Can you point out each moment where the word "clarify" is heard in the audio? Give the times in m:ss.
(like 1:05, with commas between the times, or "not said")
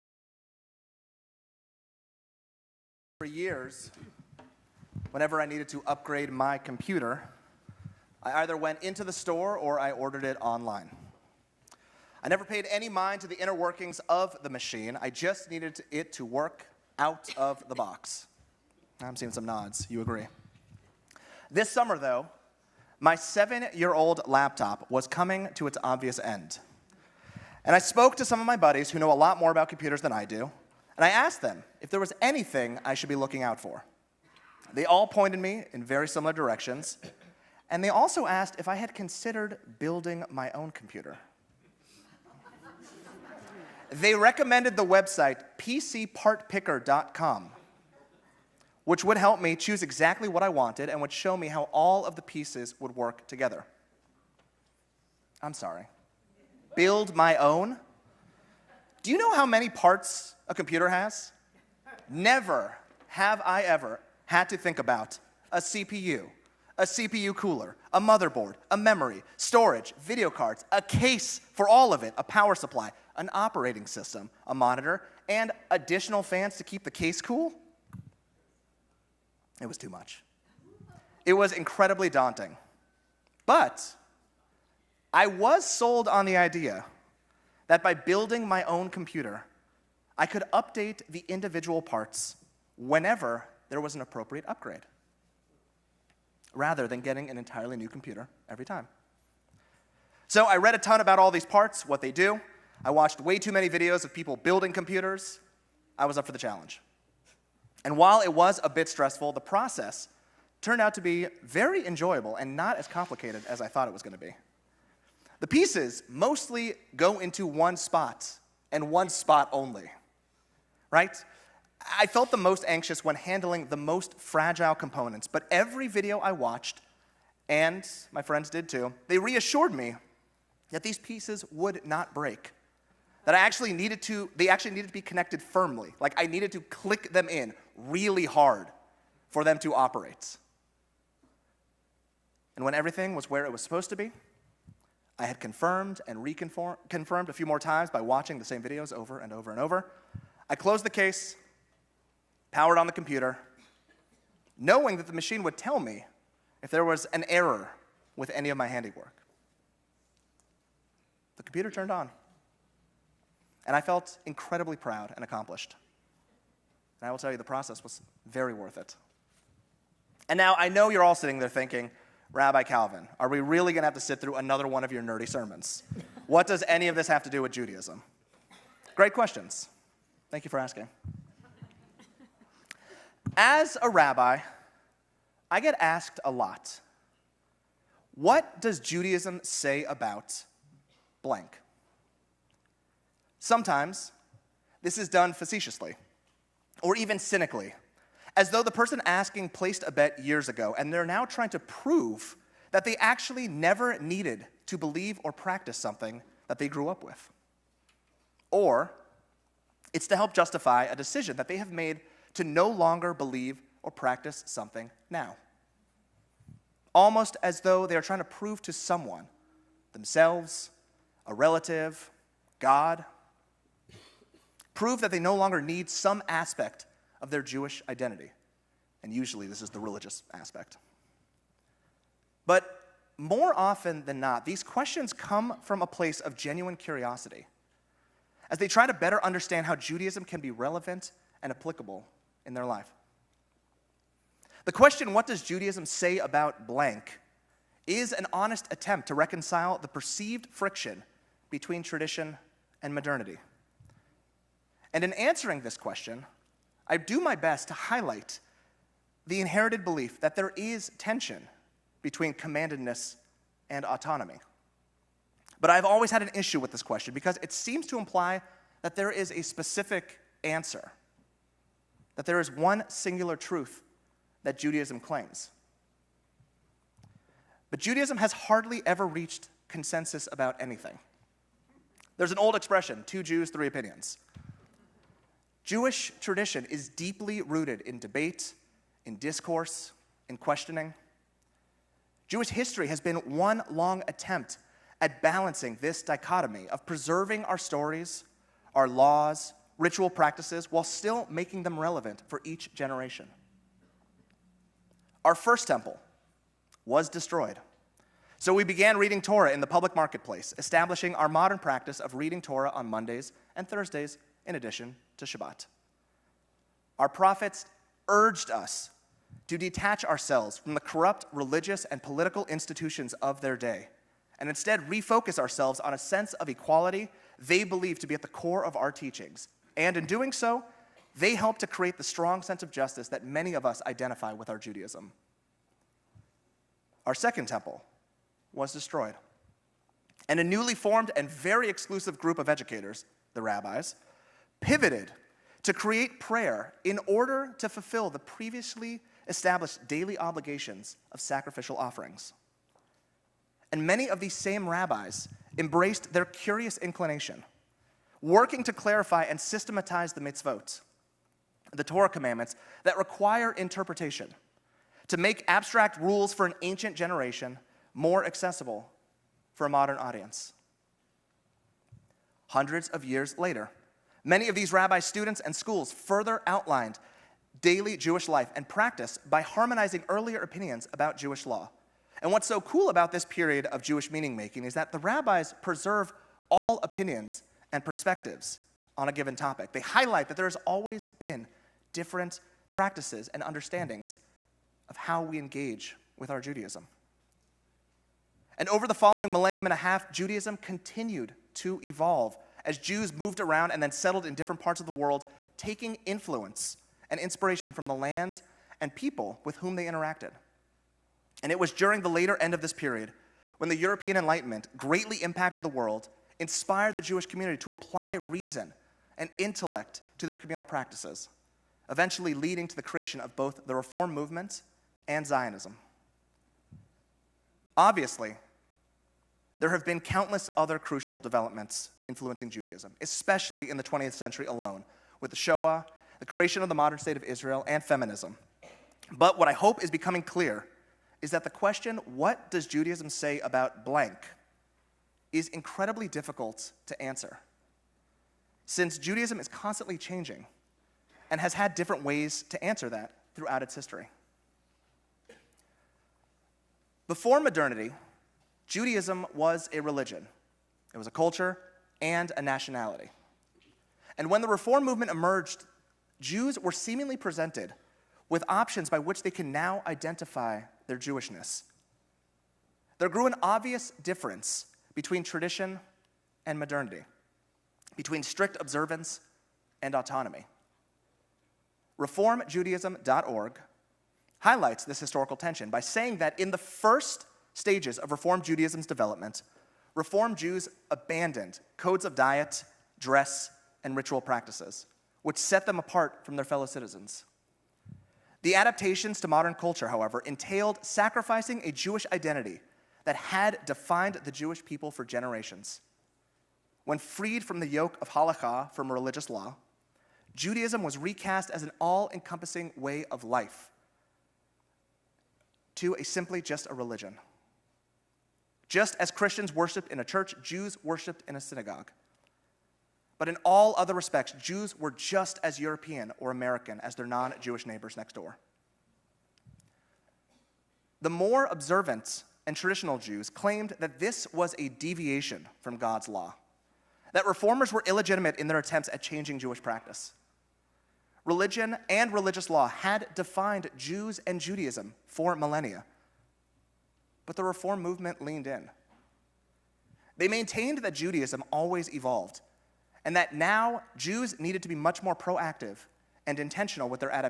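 5:58.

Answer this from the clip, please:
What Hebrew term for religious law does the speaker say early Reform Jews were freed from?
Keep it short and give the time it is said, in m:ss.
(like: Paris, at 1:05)
Halakha, at 8:28.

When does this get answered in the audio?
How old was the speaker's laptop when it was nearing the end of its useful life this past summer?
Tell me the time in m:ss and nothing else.
0:23.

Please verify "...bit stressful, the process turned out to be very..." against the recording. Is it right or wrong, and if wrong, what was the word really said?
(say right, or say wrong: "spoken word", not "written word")
right.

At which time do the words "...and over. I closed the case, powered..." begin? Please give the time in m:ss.
2:29.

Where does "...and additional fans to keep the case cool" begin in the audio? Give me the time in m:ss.
1:15.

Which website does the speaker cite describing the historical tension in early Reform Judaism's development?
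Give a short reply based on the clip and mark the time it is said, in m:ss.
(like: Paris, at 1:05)
ReformJudaism.org, at 8:01.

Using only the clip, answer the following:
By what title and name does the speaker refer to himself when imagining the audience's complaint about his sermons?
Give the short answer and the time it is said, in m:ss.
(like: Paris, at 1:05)
Rabbi Calvin, at 2:52.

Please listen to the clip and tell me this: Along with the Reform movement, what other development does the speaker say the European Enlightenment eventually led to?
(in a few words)
Zionism.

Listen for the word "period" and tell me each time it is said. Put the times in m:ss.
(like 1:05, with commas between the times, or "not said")
6:23, 6:52.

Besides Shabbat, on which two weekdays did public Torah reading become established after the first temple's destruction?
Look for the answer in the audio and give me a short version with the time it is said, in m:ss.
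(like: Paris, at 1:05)
Mondays and Thursdays, at 5:12.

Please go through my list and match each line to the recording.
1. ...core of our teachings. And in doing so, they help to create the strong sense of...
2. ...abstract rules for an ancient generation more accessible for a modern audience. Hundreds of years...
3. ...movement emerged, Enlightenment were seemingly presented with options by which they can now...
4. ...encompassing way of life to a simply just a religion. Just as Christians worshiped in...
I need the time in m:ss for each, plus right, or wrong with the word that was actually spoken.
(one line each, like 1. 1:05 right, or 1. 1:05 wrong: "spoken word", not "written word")
1. 5:28 right
2. 6:05 right
3. 7:44 wrong: "Jews", not "Enlightenment"
4. 8:32 right.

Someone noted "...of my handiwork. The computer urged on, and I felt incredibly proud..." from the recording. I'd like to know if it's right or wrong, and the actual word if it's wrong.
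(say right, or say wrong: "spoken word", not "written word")
wrong: "turned", not "urged".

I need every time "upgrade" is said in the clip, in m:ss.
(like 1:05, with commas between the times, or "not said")
0:05, 1:34.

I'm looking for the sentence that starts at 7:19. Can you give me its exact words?
But what I hope is becoming clear is that the question, what does Judaism say about blank, is incredibly difficult to answer.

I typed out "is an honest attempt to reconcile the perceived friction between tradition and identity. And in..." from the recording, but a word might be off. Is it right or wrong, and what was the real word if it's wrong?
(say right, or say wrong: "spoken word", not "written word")
wrong: "modernity", not "identity".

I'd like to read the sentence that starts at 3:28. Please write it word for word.
Or it's to help justify a decision that they have made to no longer believe or practice something now.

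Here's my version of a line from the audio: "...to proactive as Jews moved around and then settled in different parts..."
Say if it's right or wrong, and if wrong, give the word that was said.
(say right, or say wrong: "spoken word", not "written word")
wrong: "evolve", not "proactive".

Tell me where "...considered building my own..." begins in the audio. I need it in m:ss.
0:38.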